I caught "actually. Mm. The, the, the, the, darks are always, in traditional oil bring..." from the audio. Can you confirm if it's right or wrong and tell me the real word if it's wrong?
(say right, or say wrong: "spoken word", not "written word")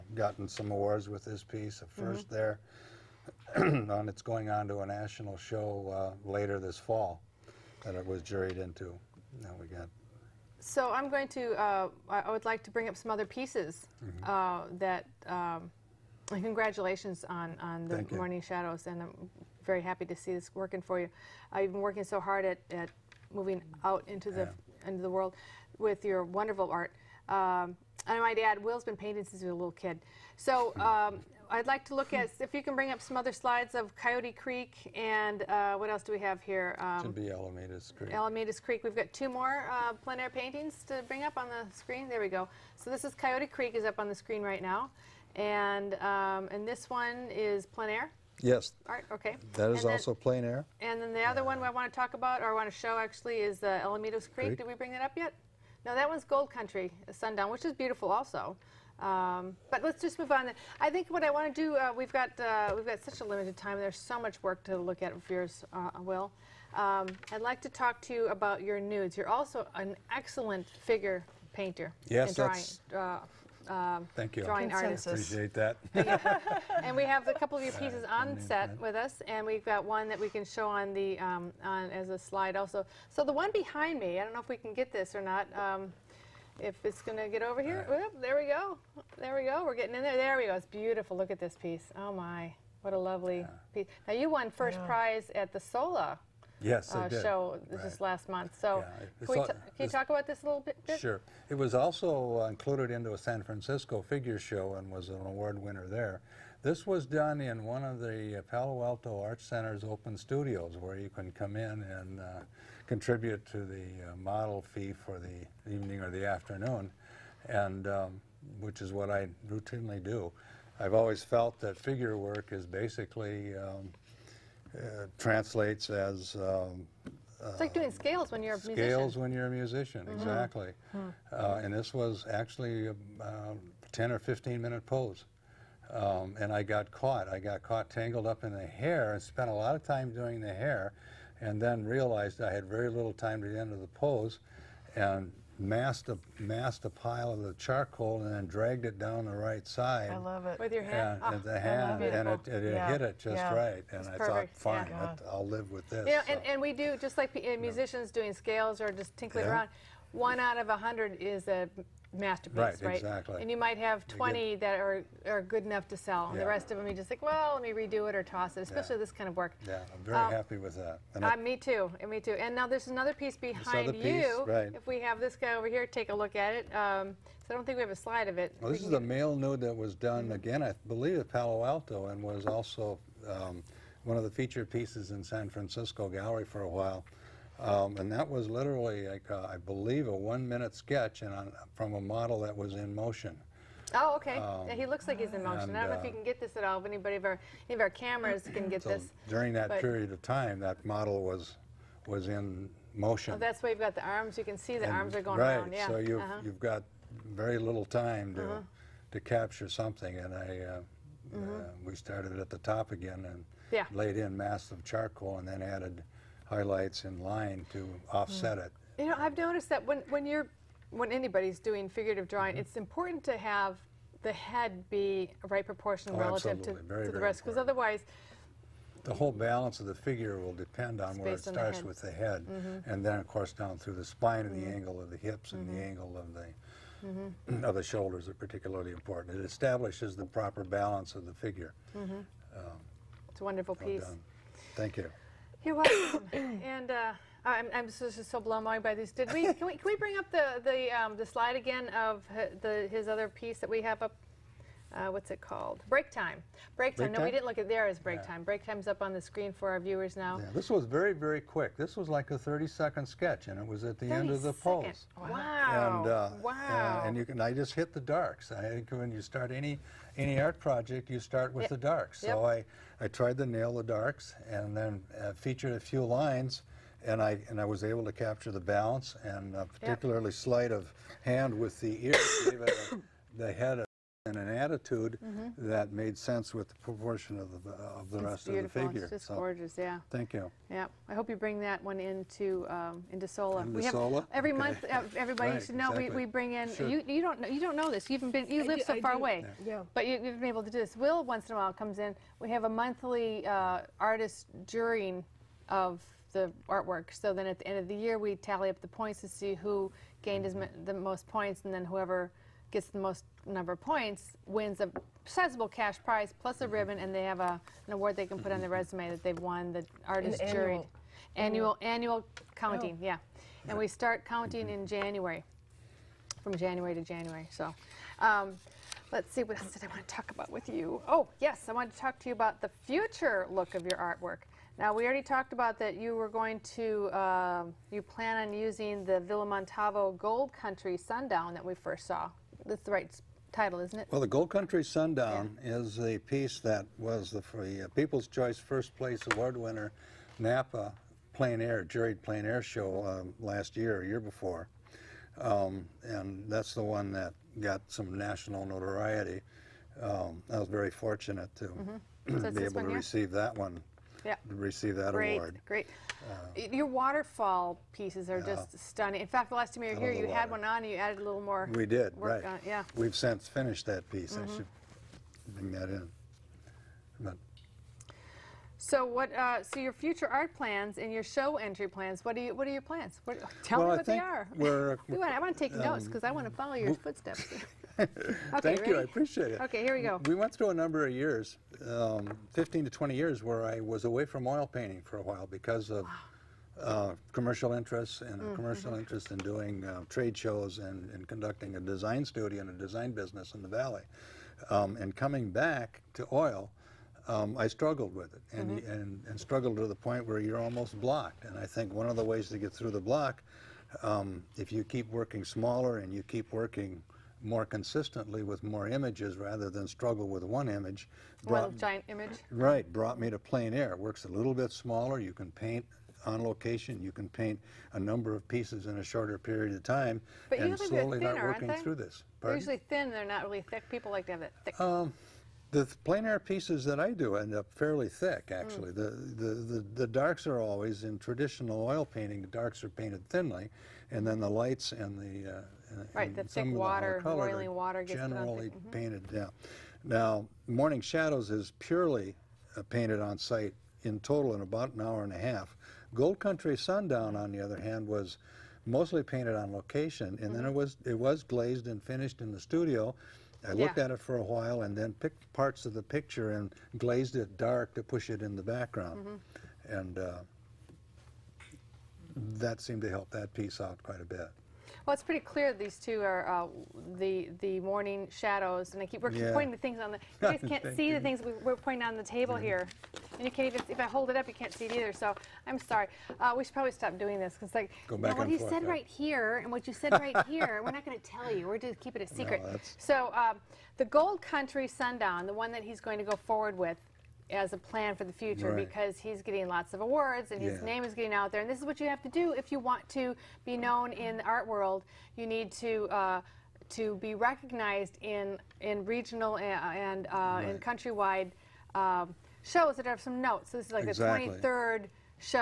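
wrong: "painting", not "bring".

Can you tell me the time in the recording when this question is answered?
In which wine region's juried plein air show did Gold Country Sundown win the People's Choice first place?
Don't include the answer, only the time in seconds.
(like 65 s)
350 s.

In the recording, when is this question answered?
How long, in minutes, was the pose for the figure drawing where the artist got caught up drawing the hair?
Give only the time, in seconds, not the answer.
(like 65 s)
133 s.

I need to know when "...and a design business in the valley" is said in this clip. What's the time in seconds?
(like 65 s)
402 s.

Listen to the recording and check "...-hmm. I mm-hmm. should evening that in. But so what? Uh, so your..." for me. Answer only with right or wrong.
wrong.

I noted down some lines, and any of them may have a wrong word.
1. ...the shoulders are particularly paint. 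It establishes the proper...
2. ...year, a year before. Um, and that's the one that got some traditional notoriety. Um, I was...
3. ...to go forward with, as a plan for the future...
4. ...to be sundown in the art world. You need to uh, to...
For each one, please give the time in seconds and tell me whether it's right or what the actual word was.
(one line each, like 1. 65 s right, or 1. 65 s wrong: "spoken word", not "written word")
1. 237 s wrong: "important", not "paint"
2. 353 s wrong: "national", not "traditional"
3. 496 s right
4. 503 s wrong: "known", not "sundown".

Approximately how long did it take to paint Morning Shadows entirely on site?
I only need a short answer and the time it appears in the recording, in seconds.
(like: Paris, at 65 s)
an hour and a half, at 454 s.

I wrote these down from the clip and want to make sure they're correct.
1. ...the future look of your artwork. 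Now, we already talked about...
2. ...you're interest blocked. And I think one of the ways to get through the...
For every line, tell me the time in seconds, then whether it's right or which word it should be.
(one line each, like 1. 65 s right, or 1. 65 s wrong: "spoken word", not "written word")
1. 332 s right
2. 410 s wrong: "almost", not "interest".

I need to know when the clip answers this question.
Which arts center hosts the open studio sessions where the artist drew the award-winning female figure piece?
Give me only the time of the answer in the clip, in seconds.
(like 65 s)
108 s.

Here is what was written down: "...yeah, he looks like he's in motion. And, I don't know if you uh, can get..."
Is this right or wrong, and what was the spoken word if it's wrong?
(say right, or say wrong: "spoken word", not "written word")
right.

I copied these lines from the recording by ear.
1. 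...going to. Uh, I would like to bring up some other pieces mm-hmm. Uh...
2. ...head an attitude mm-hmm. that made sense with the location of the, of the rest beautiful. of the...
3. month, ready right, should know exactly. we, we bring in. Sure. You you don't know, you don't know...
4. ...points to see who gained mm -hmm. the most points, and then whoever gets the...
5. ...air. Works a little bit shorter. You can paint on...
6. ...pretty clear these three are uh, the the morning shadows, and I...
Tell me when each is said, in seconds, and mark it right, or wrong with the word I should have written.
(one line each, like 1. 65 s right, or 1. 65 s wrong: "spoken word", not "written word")
1. 11 s right
2. 283 s wrong: "proportion", not "location"
3. 294 s wrong: "everybody", not "ready"
4. 308 s right
5. 423 s wrong: "smaller", not "shorter"
6. 475 s wrong: "two", not "three".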